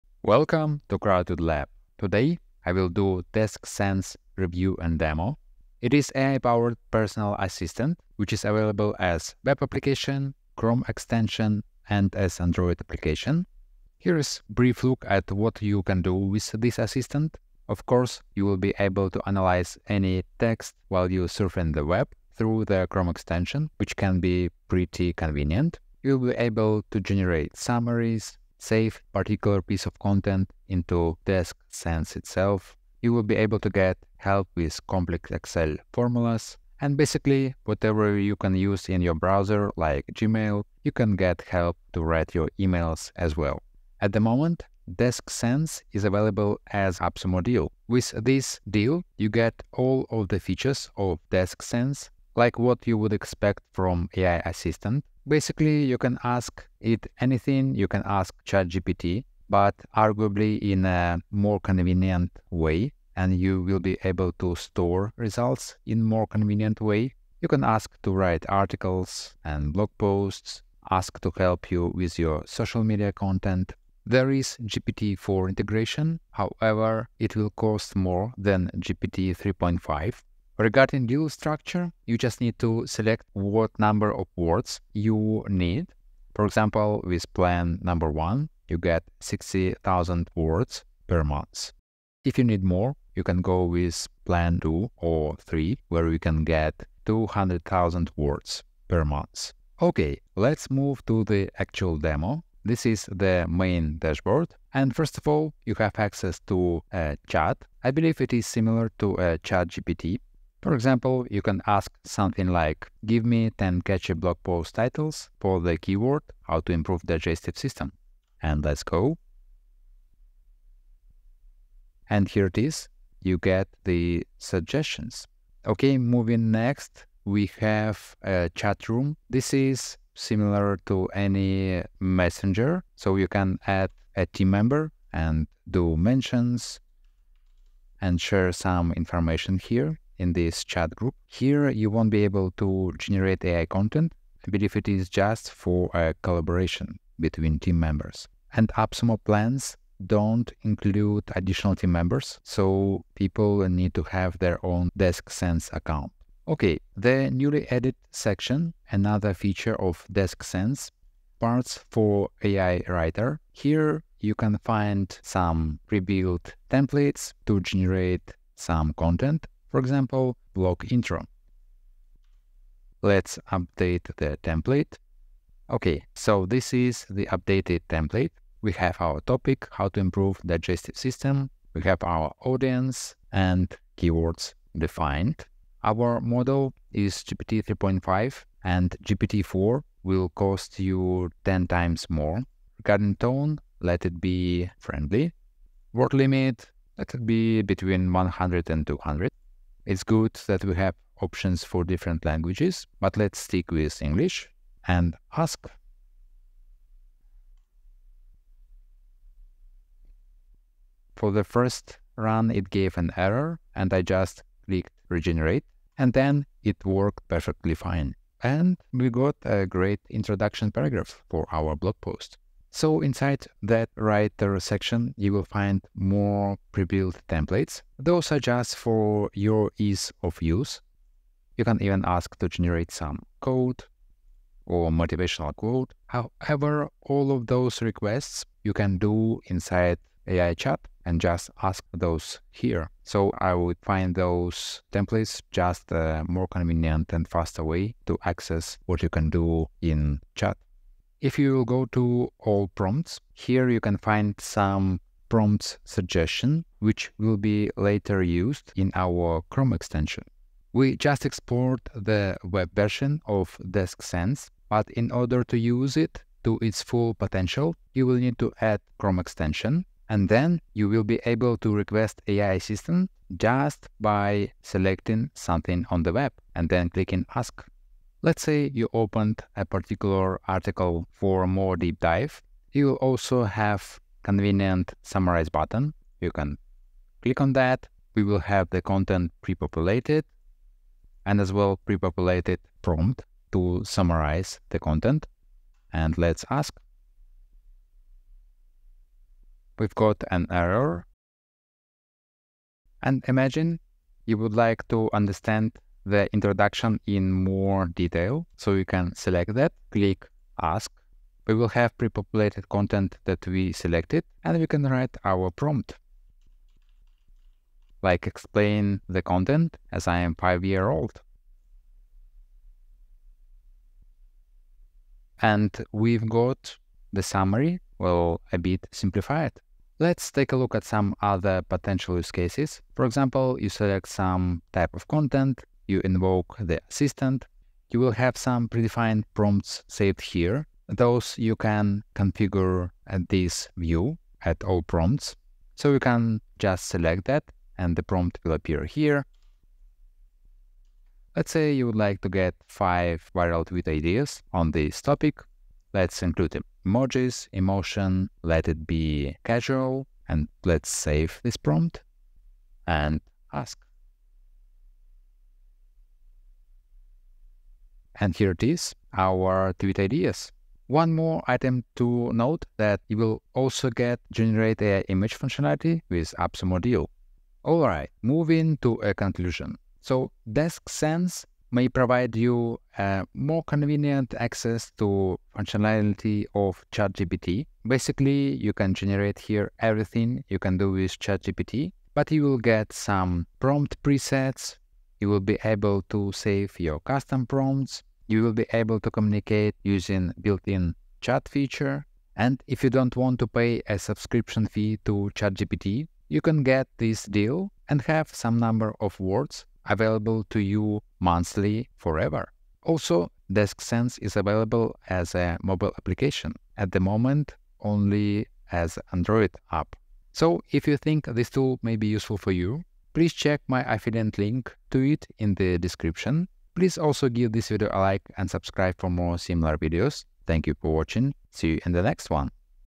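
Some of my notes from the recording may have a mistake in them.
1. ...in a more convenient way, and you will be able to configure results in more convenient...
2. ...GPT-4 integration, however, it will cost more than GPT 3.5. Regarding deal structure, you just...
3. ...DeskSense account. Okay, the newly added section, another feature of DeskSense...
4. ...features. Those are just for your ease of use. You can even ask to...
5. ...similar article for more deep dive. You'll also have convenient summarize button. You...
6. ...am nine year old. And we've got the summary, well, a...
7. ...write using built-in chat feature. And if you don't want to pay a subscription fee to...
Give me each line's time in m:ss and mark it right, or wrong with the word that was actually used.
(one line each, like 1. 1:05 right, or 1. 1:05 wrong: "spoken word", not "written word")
1. 1:00 wrong: "store", not "configure"
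2. 1:14 right
3. 2:35 right
4. 3:47 wrong: "templates", not "features"
5. 4:39 wrong: "particular", not "similar"
6. 5:20 wrong: "five", not "nine"
7. 6:39 wrong: "communicate", not "write".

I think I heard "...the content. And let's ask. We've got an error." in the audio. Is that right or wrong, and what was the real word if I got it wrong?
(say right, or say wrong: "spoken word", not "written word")
right.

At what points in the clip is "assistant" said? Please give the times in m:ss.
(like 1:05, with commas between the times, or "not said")
0:07, 0:16, 0:54, 4:32, 5:36.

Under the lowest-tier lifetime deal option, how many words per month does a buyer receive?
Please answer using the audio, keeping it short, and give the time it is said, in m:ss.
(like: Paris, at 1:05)
60,000, at 1:29.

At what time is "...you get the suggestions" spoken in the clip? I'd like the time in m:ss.
2:03.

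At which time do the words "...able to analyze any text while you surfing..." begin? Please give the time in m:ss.
0:18.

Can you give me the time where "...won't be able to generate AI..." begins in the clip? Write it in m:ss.
2:21.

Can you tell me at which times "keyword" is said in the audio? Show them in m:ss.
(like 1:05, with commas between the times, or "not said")
1:55, 3:03.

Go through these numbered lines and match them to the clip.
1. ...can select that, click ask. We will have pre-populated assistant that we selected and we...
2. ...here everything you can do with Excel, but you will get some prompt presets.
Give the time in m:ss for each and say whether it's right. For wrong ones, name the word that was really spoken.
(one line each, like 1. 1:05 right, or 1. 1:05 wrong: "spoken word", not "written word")
1. 5:08 wrong: "content", not "assistant"
2. 6:29 wrong: "ChatGPT", not "Excel".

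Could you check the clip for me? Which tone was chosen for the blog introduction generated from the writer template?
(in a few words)
friendly.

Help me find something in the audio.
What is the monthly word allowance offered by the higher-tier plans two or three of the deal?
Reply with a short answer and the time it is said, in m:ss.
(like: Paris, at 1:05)
200,000, at 1:37.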